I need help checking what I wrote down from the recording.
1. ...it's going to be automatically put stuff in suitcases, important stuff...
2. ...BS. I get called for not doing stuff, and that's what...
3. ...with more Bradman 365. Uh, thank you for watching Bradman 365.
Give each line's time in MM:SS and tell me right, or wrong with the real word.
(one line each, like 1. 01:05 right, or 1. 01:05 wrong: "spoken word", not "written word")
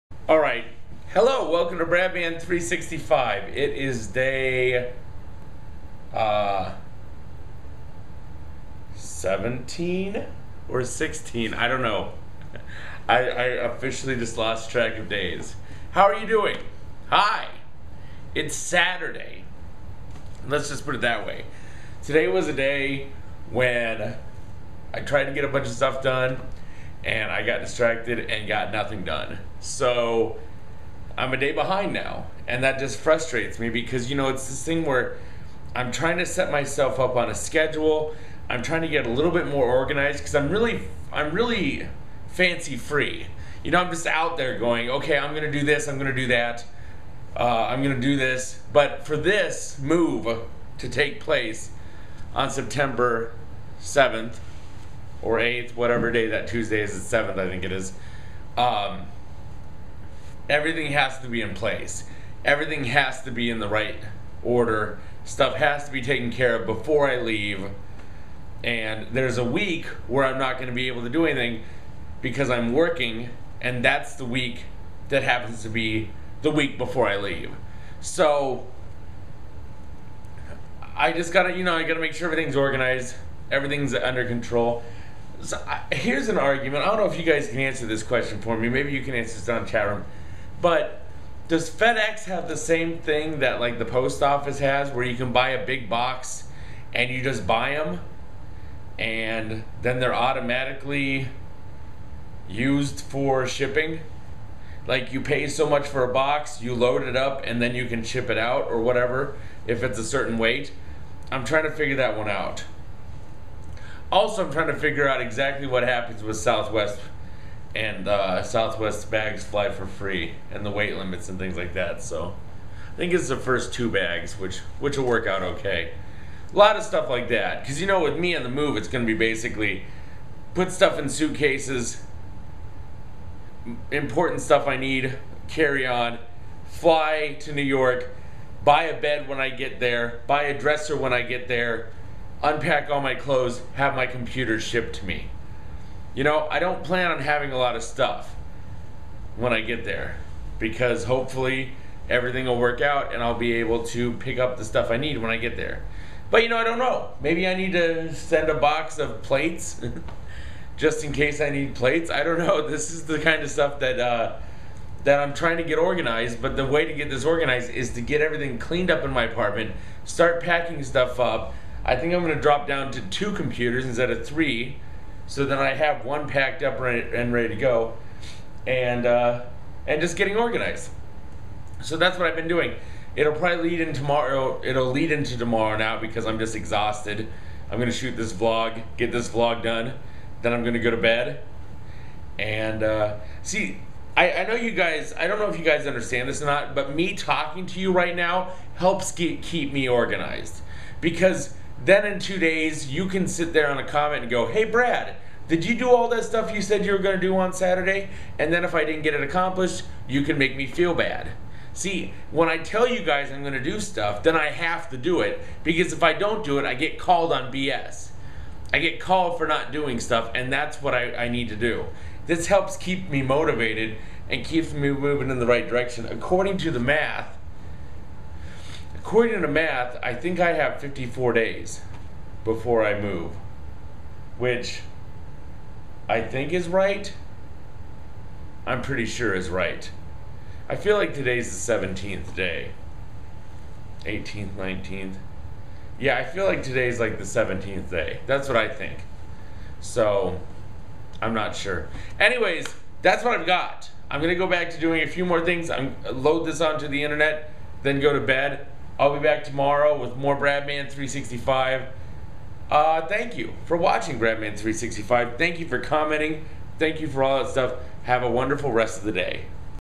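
1. 02:08 wrong: "basically", not "automatically"
2. 03:37 right
3. 04:19 right.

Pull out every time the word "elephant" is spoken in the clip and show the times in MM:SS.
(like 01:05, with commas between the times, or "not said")
not said.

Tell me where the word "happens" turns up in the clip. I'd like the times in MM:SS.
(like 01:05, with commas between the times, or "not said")
01:15, 01:55.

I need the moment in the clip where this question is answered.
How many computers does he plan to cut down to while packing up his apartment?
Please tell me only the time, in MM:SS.
02:53.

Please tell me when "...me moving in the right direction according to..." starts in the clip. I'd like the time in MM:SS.
03:44.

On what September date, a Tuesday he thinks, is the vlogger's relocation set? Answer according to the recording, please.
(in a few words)
September 7th.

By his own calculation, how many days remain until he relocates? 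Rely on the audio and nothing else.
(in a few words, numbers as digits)
54.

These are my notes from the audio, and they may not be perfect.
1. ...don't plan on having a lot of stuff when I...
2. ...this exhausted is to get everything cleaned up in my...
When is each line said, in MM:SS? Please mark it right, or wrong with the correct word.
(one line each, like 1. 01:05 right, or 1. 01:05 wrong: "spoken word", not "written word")
1. 02:26 right
2. 02:47 wrong: "organized", not "exhausted".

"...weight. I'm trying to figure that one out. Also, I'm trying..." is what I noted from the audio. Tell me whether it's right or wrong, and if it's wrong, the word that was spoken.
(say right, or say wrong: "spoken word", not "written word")
right.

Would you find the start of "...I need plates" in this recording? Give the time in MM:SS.
02:41.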